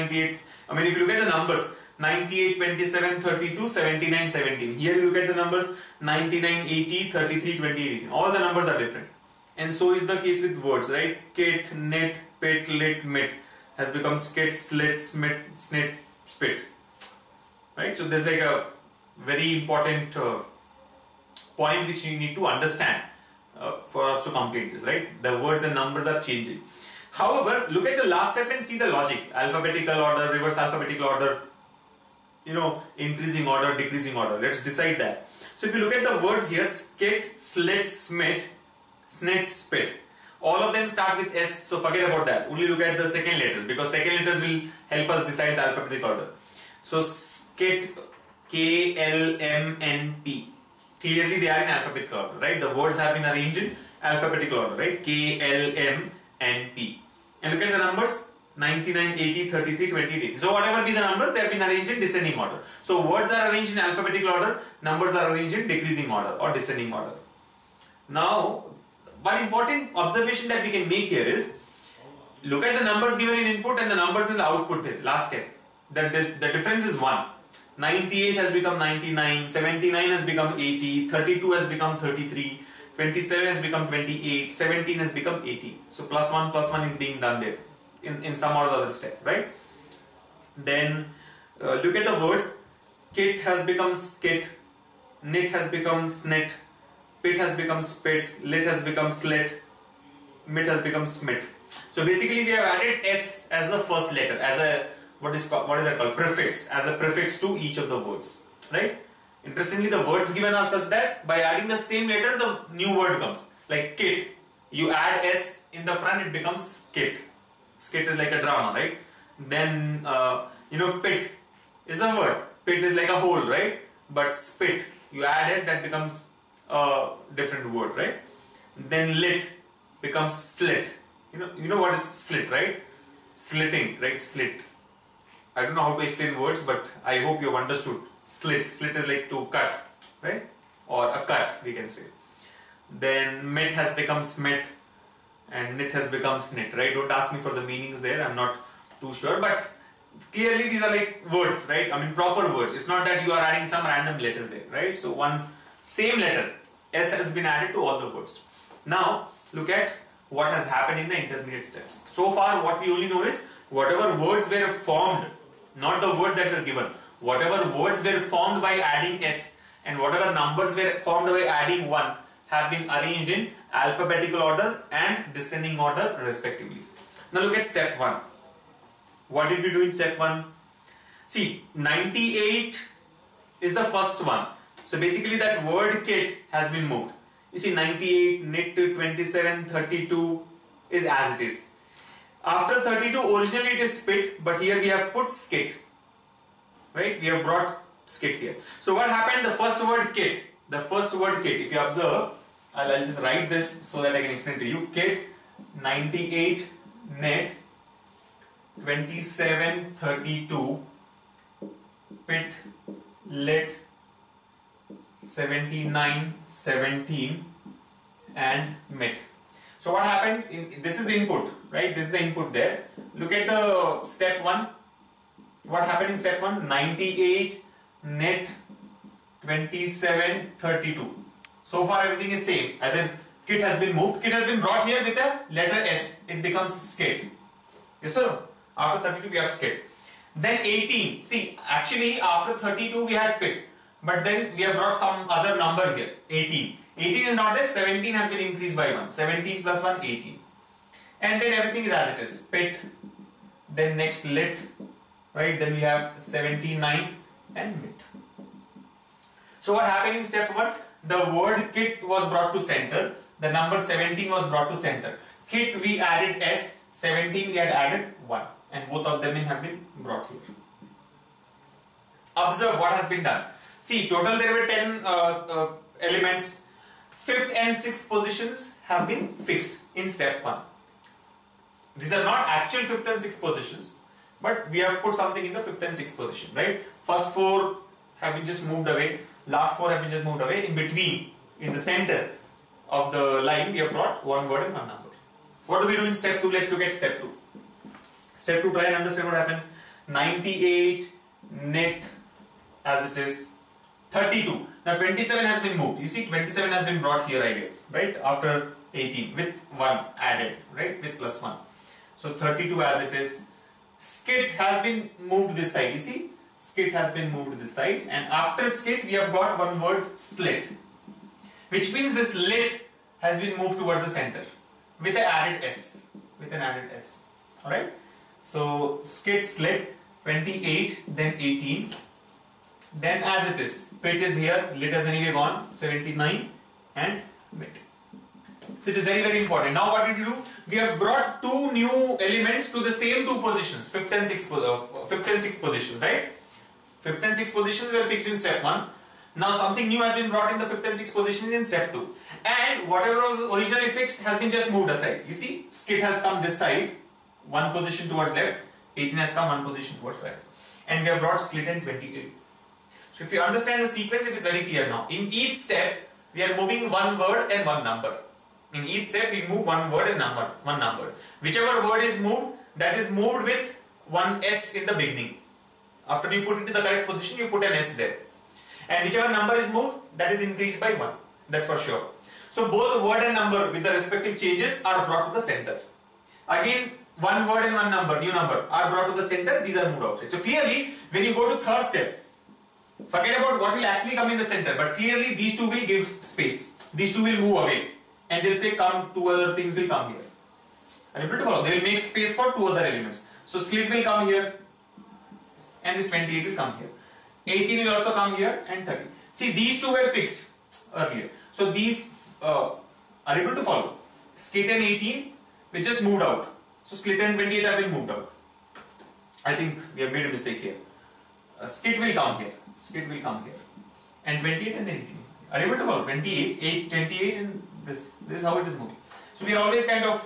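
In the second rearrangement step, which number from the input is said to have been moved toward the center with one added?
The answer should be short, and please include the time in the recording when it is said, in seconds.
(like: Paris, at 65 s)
27, at 304 s.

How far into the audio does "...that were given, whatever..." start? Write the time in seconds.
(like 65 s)
166 s.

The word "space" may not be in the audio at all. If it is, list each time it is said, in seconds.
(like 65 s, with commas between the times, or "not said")
396 s, 401 s.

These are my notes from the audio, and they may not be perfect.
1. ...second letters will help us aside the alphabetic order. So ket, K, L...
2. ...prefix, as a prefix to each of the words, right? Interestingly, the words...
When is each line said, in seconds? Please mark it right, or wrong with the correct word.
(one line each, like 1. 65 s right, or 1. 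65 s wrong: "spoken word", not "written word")
1. 43 s wrong: "decide", not "aside"
2. 106 s right.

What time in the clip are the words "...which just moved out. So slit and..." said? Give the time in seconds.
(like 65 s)
415 s.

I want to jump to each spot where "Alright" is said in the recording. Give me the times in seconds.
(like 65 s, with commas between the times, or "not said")
327 s.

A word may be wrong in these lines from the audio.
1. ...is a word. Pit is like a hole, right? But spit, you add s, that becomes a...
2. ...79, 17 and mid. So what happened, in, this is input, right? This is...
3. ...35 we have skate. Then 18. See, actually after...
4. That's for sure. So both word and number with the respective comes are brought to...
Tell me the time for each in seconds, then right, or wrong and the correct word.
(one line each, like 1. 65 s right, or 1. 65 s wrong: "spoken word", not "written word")
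1. 121 s right
2. 215 s right
3. 239 s wrong: "32", not "35"
4. 381 s wrong: "changes", not "comes".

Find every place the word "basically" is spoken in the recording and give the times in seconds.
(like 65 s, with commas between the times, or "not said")
102 s, 185 s.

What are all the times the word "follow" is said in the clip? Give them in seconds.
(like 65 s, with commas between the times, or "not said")
401 s, 413 s, 425 s.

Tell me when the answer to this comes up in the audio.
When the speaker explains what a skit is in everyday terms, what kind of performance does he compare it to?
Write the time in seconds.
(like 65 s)
118 s.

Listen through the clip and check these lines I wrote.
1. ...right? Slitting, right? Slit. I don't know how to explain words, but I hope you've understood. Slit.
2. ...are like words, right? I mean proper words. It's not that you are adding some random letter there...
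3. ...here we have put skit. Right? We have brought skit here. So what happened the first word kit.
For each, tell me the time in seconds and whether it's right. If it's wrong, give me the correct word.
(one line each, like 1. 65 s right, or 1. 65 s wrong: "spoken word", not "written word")
1. 132 s right
2. 150 s right
3. 194 s right.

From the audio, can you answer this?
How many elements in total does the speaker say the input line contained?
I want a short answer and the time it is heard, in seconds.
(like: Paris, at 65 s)
10, at 274 s.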